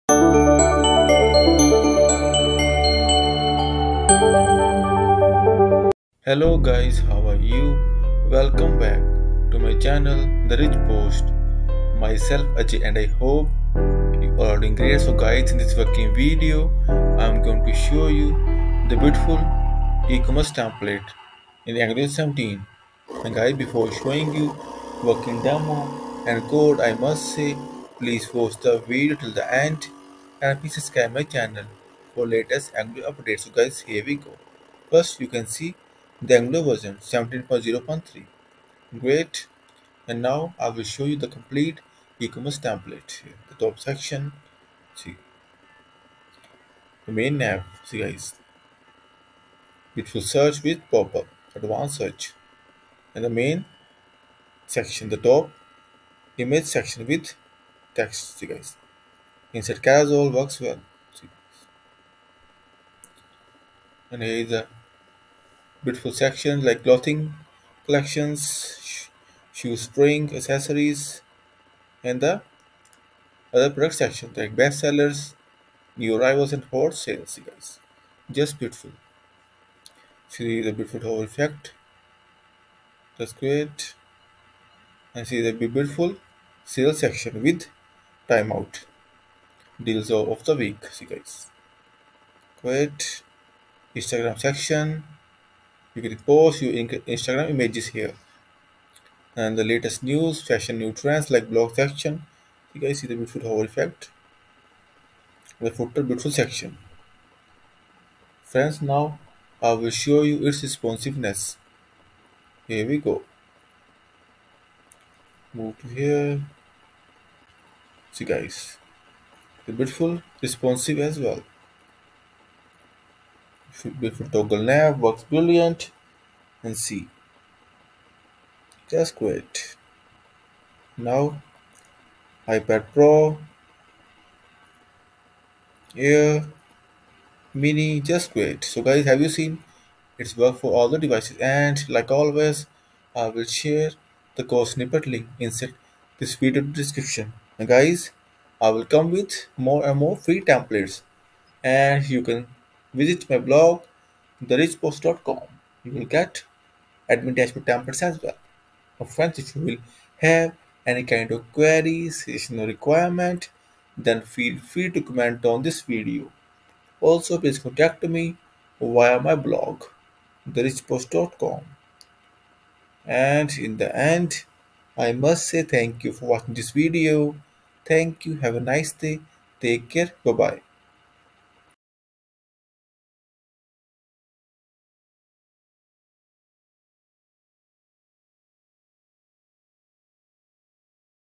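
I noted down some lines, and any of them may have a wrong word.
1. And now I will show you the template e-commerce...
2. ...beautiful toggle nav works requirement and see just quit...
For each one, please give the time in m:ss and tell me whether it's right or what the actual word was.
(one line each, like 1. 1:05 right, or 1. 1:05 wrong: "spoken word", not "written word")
1. 0:40 wrong: "complete", not "template"
2. 2:03 wrong: "brilliant", not "requirement".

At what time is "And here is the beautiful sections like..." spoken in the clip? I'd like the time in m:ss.
1:04.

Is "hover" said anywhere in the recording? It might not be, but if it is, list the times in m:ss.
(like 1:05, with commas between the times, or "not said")
1:21, 1:43.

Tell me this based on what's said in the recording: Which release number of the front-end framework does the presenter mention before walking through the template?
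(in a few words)
17.0.3.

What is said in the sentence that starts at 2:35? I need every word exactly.
You will get admin dashboard templates as well.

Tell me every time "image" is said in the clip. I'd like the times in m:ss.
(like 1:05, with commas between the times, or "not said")
0:56, 1:37.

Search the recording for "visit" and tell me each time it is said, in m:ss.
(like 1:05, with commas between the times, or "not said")
2:32.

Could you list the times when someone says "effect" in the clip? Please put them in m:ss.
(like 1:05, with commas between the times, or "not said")
1:21, 1:43.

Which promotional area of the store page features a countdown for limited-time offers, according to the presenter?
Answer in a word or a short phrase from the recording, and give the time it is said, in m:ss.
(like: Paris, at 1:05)
deals of the week, at 1:29.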